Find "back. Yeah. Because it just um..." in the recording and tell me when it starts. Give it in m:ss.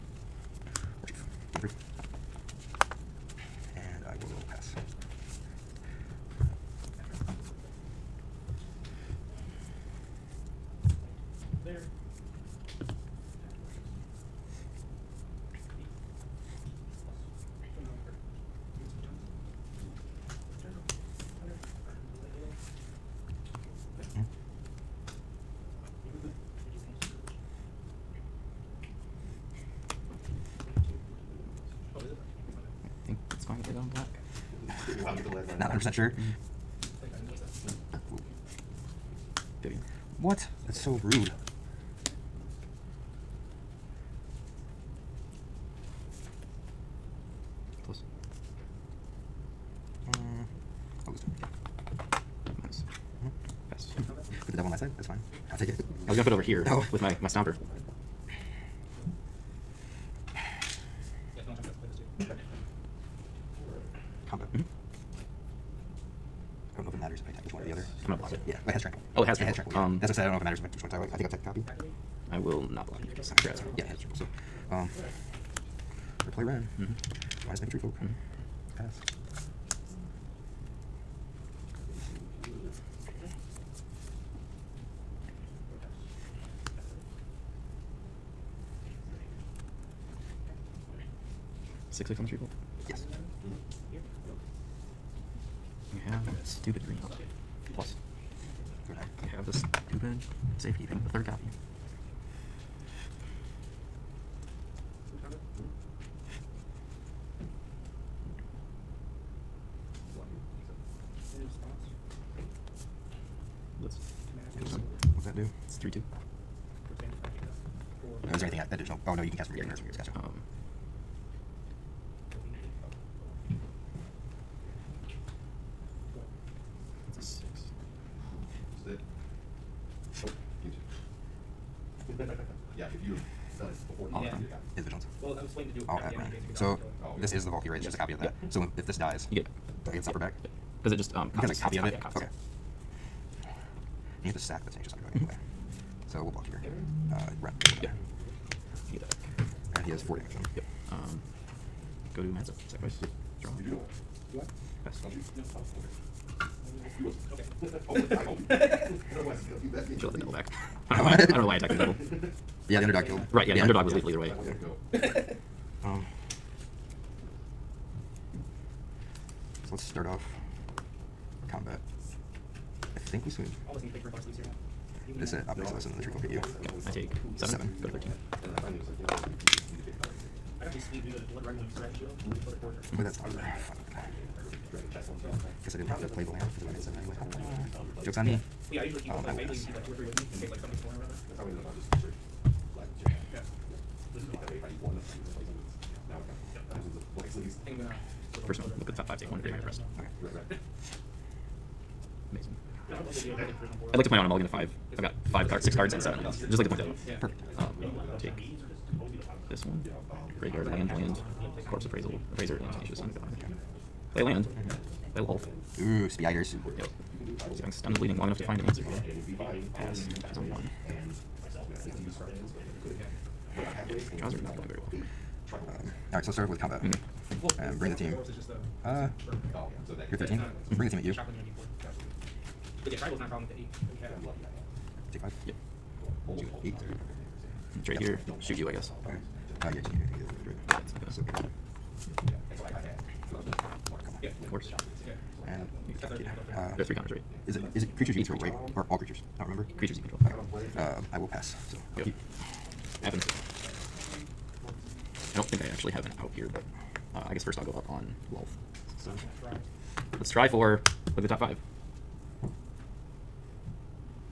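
2:20.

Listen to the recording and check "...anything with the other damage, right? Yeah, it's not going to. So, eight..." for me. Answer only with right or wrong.
right.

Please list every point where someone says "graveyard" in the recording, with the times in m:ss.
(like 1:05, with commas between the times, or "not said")
1:59, 3:19, 3:30.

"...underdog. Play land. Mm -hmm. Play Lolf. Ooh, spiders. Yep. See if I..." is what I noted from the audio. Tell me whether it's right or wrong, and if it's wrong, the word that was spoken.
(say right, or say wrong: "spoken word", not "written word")
right.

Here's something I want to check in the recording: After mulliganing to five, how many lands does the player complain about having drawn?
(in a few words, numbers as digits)
7.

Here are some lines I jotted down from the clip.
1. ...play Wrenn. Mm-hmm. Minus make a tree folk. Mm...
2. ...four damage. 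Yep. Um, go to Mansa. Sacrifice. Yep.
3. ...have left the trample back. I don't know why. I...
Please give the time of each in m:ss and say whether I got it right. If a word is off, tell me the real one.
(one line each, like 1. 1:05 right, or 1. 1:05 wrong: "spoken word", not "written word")
1. 1:16 right
2. 2:30 right
3. 2:40 wrong: "double", not "trample".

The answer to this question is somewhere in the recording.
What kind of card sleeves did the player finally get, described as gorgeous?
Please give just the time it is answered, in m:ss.
3:01.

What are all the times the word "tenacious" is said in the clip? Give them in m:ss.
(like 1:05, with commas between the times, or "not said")
2:24, 3:32.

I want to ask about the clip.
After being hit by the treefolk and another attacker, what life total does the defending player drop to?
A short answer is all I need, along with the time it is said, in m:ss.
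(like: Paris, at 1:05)
13, at 2:57.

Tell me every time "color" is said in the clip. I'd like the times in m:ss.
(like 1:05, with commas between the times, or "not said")
2:54.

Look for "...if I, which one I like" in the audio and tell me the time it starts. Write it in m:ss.
1:10.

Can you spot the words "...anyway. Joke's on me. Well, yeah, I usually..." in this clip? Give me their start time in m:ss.
3:07.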